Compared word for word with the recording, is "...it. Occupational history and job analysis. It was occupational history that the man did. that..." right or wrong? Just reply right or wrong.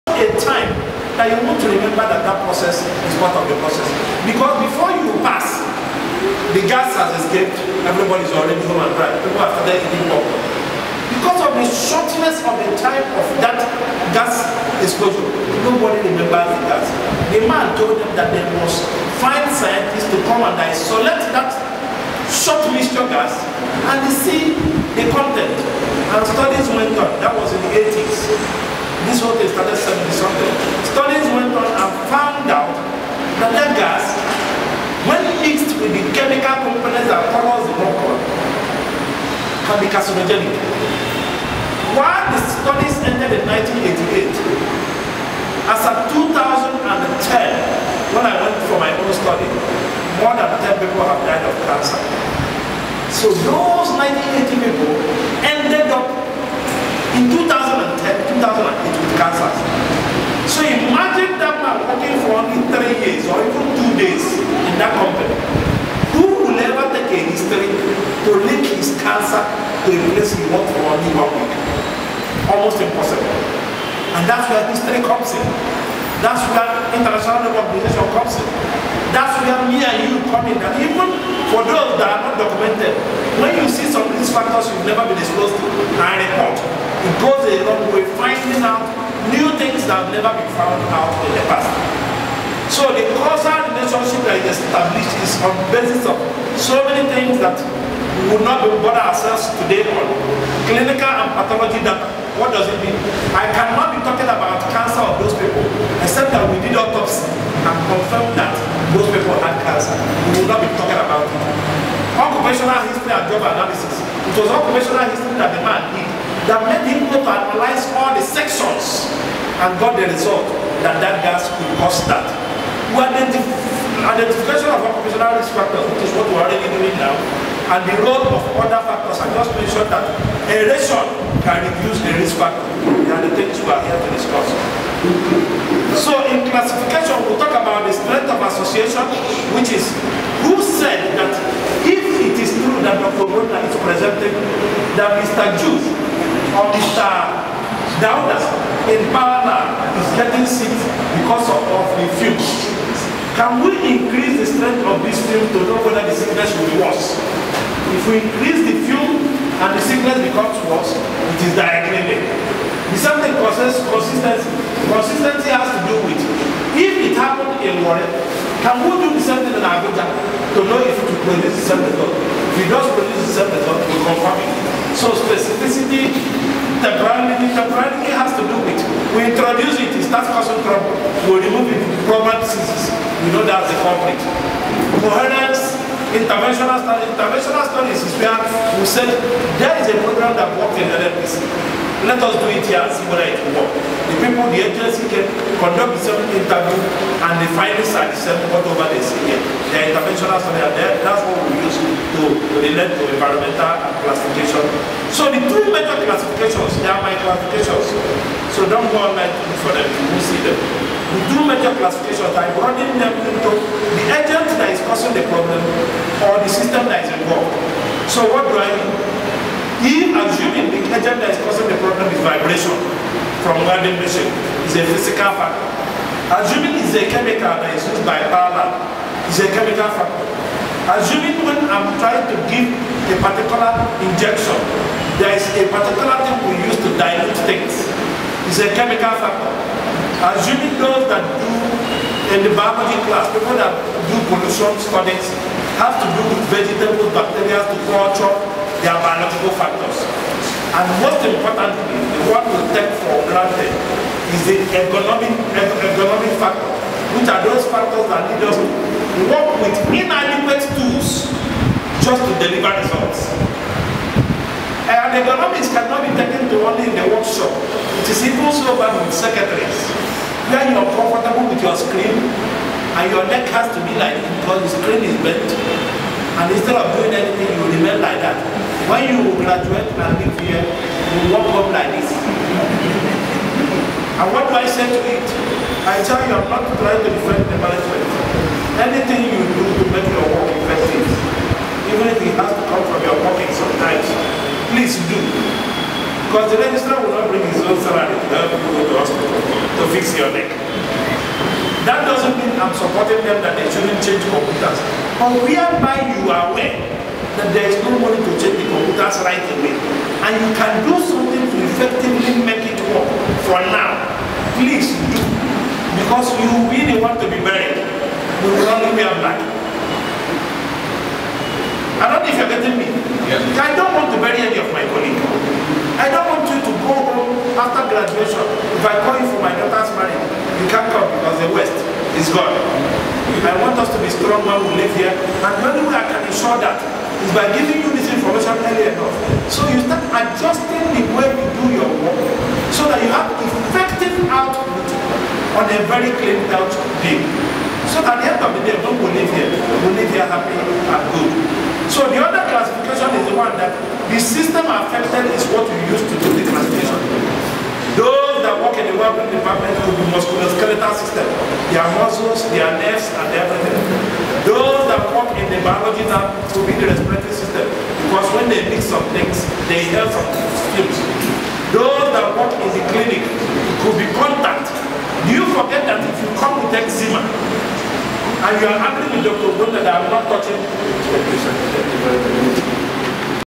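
right.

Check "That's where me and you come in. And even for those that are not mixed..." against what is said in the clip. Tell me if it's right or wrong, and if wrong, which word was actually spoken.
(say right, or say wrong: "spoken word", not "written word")
wrong: "documented", not "mixed".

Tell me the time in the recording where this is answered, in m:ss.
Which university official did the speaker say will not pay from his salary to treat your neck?
4:56.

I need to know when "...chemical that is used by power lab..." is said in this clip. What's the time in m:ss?
3:47.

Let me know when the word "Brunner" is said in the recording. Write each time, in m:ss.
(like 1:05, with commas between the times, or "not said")
2:23, 6:19.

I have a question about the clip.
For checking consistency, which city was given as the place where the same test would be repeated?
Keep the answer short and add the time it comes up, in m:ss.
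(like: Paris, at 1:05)
Abuja, at 2:49.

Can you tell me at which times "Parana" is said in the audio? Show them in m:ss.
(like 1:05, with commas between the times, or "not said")
2:29.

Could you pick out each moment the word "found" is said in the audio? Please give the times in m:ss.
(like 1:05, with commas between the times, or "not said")
0:32, 1:30.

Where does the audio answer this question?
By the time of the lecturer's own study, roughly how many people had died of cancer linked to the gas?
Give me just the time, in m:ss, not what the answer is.
0:50.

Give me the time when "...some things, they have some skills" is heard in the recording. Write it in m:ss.
6:08.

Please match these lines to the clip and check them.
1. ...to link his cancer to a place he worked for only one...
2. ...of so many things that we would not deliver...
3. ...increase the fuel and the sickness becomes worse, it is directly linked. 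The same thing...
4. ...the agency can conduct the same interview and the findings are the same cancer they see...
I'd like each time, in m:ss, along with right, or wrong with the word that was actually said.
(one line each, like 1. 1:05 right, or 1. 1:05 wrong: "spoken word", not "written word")
1. 1:07 right
2. 1:36 wrong: "bother", not "deliver"
3. 2:38 right
4. 3:14 wrong: "whatever", not "cancer".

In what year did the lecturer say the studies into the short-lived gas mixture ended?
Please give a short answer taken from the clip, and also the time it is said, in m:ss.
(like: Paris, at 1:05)
1988, at 0:43.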